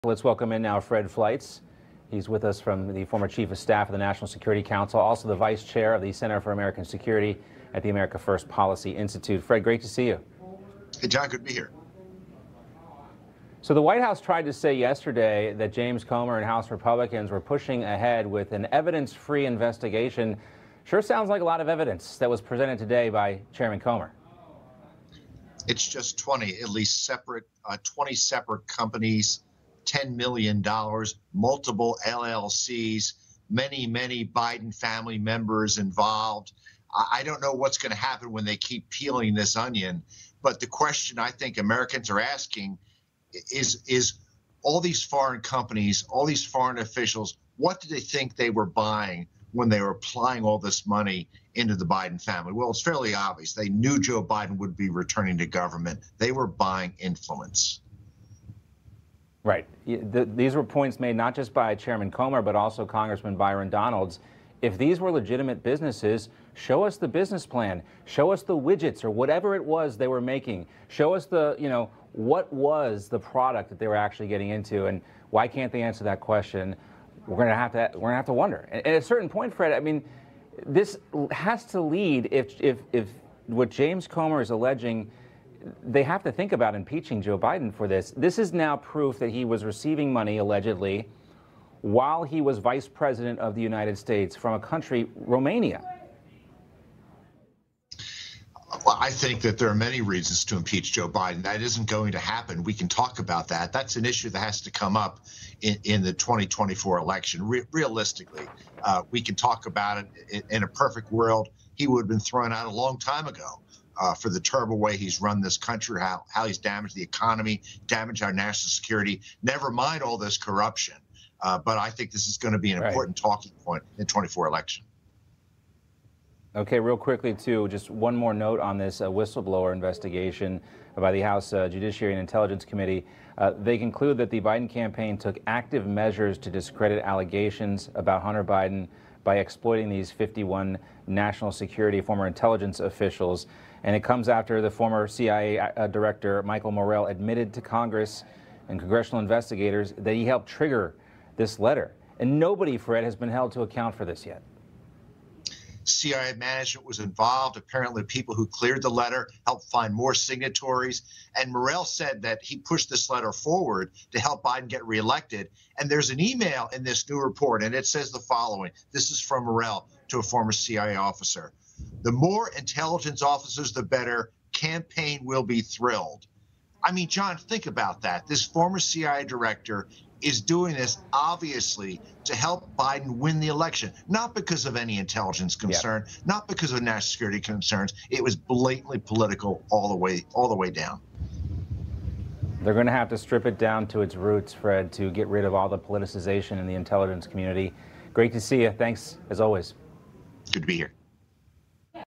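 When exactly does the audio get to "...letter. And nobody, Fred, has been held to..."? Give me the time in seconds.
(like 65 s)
151 s.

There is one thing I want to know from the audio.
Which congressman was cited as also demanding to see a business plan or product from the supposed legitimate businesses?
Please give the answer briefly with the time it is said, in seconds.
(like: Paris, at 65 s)
Byron Donalds, at 63 s.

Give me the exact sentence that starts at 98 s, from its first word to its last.
Well, I think that there are many reasons to impeach Joe Biden.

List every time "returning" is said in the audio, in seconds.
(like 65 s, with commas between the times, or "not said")
54 s.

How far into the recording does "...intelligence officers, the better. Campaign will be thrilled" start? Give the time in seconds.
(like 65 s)
172 s.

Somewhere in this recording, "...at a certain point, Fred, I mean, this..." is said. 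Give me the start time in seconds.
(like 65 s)
78 s.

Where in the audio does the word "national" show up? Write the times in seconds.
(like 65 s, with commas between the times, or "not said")
3 s, 118 s, 141 s, 186 s.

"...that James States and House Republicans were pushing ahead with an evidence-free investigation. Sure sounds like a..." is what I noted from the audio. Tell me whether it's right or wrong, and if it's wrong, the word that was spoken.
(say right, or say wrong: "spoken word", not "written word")
wrong: "Comer", not "States".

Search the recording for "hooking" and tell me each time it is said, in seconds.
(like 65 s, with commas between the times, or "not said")
not said.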